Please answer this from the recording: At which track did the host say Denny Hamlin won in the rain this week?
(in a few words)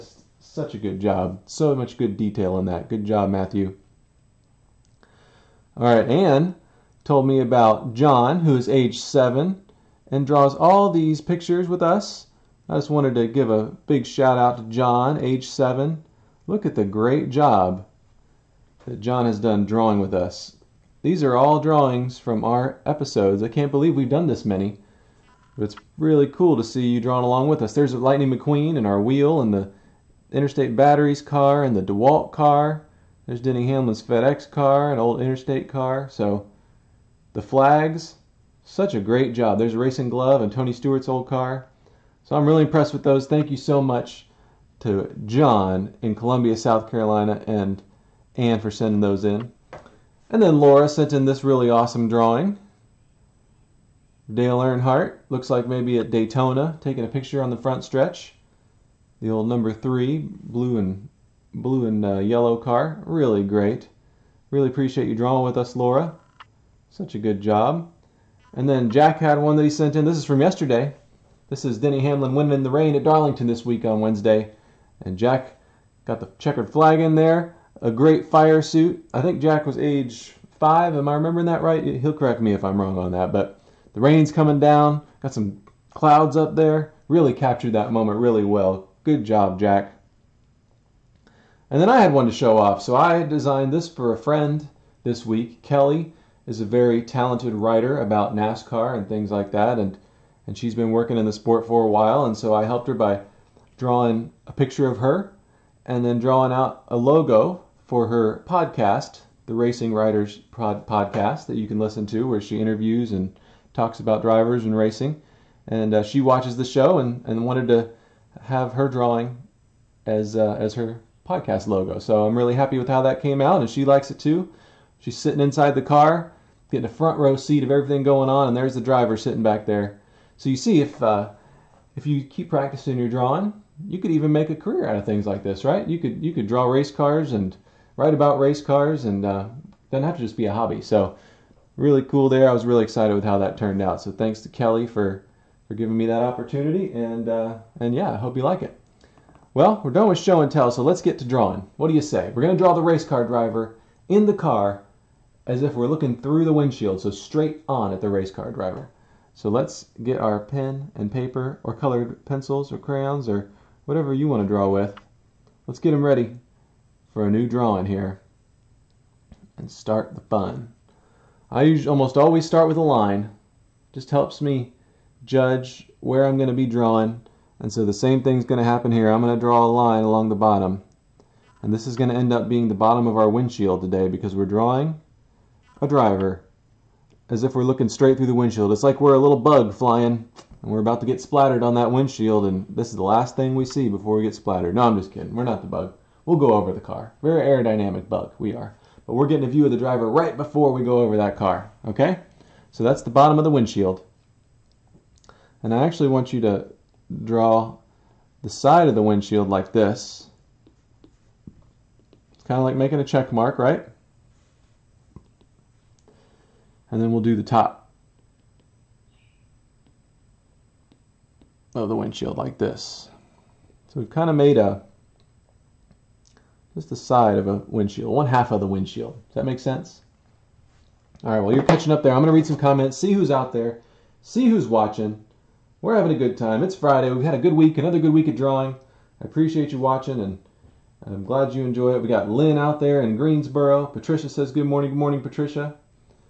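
Darlington.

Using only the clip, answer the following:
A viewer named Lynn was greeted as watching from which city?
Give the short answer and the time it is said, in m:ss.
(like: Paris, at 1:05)
Greensboro, at 4:03.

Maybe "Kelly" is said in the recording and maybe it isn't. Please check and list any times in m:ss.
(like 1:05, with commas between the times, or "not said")
1:35, 2:24.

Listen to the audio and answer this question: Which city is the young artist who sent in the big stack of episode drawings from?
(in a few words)
Columbia, South Carolina.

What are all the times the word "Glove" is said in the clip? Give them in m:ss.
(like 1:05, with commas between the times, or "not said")
0:40.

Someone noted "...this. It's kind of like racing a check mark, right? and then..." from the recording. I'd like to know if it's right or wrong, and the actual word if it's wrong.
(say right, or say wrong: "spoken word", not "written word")
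wrong: "making", not "racing".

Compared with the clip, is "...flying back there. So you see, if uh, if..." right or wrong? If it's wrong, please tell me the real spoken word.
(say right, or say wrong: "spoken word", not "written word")
wrong: "sitting", not "flying".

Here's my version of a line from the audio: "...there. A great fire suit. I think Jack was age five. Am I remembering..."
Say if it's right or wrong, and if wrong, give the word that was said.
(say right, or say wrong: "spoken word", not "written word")
right.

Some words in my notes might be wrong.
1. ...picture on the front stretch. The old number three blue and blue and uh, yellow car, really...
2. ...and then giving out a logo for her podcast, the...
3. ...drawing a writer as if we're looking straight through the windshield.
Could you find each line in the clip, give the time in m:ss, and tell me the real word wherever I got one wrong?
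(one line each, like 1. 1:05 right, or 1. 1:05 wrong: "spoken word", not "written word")
1. 0:57 right
2. 1:45 wrong: "drawing", not "giving"
3. 3:04 wrong: "driver", not "writer".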